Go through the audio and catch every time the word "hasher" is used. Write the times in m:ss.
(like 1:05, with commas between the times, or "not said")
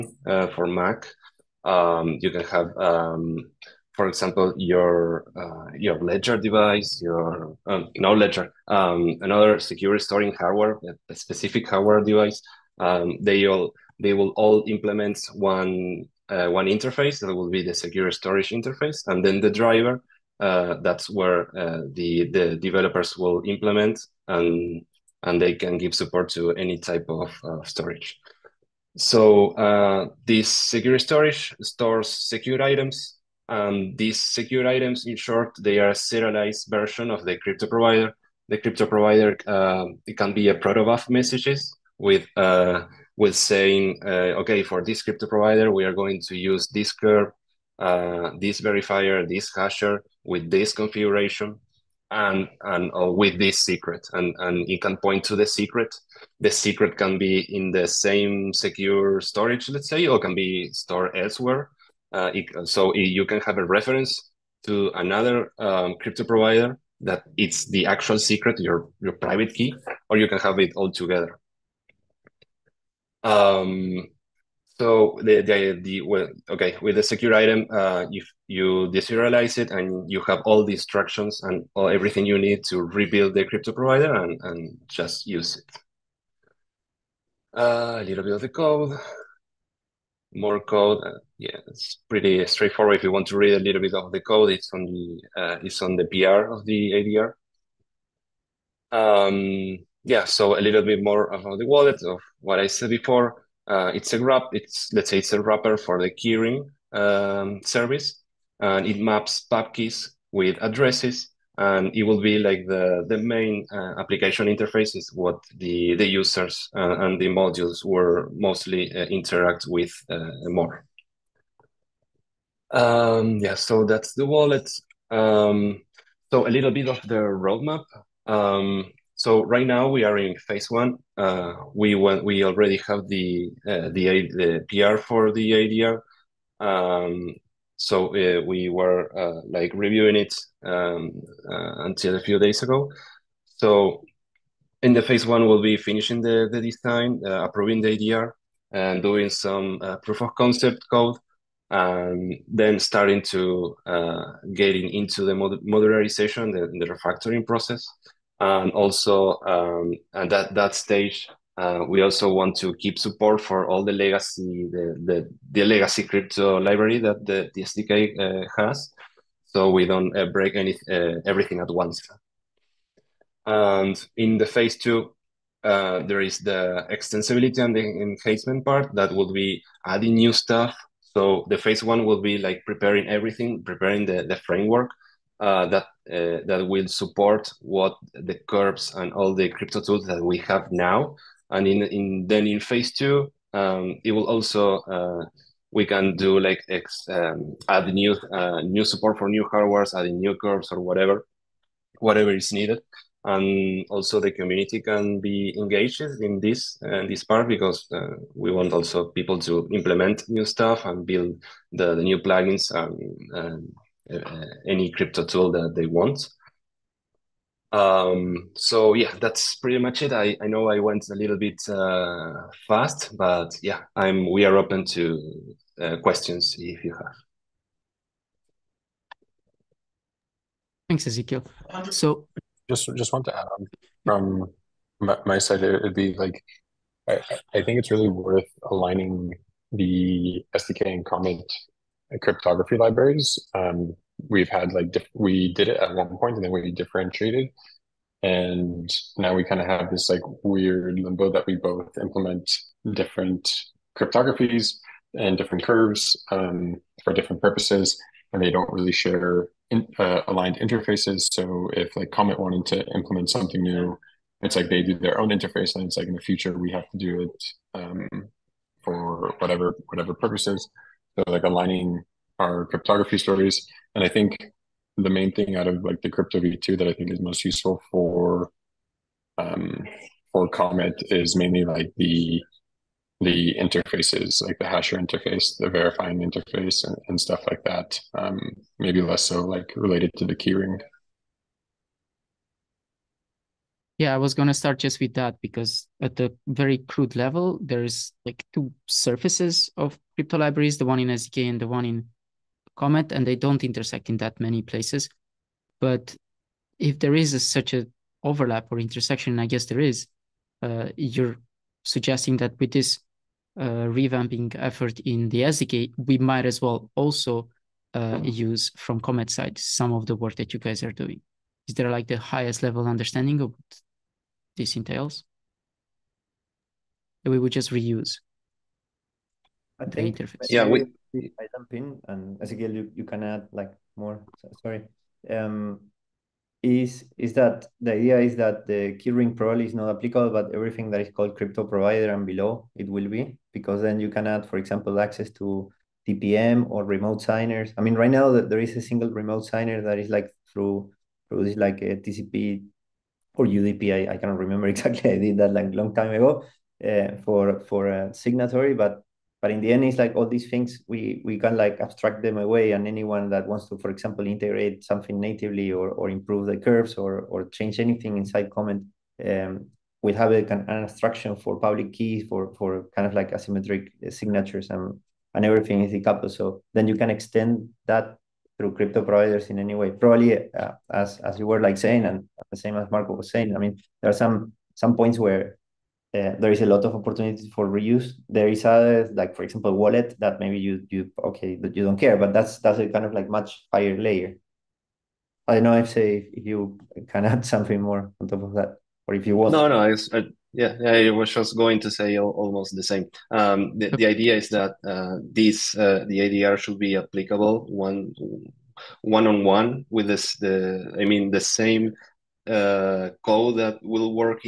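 0:49, 4:44.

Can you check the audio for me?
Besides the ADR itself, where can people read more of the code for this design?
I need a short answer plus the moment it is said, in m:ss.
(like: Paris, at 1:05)
the PR of the ADR, at 1:36.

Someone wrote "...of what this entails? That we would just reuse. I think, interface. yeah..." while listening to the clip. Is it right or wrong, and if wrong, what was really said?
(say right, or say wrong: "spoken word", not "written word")
right.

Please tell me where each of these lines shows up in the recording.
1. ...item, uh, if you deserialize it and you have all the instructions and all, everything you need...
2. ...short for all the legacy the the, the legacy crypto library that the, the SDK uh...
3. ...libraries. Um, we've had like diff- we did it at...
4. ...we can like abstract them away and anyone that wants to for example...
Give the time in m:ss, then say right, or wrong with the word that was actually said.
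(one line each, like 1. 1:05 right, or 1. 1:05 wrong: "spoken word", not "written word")
1. 1:17 right
2. 2:42 wrong: "support", not "short"
3. 4:02 right
4. 6:01 right.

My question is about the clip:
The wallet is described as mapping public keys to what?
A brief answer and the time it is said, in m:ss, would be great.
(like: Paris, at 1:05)
addresses, at 1:50.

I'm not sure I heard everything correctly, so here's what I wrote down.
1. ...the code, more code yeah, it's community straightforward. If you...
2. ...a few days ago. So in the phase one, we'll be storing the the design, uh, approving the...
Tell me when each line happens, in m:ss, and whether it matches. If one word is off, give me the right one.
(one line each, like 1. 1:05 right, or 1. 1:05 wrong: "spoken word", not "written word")
1. 1:28 wrong: "pretty", not "community"
2. 2:22 wrong: "finishing", not "storing".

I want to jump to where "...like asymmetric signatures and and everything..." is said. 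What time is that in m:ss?
6:13.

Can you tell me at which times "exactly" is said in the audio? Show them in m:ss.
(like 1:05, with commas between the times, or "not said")
5:54.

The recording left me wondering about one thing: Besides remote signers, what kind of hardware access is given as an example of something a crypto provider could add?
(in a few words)
TPM.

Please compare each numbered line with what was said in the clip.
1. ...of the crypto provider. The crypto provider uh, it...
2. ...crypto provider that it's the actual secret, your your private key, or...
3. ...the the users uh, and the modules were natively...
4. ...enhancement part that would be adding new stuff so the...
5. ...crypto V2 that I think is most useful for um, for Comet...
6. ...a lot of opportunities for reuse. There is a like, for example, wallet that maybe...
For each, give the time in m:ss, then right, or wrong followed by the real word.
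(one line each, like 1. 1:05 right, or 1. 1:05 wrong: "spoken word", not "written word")
1. 0:37 right
2. 1:05 right
3. 1:55 wrong: "mostly", not "natively"
4. 2:57 right
5. 4:36 right
6. 6:26 right.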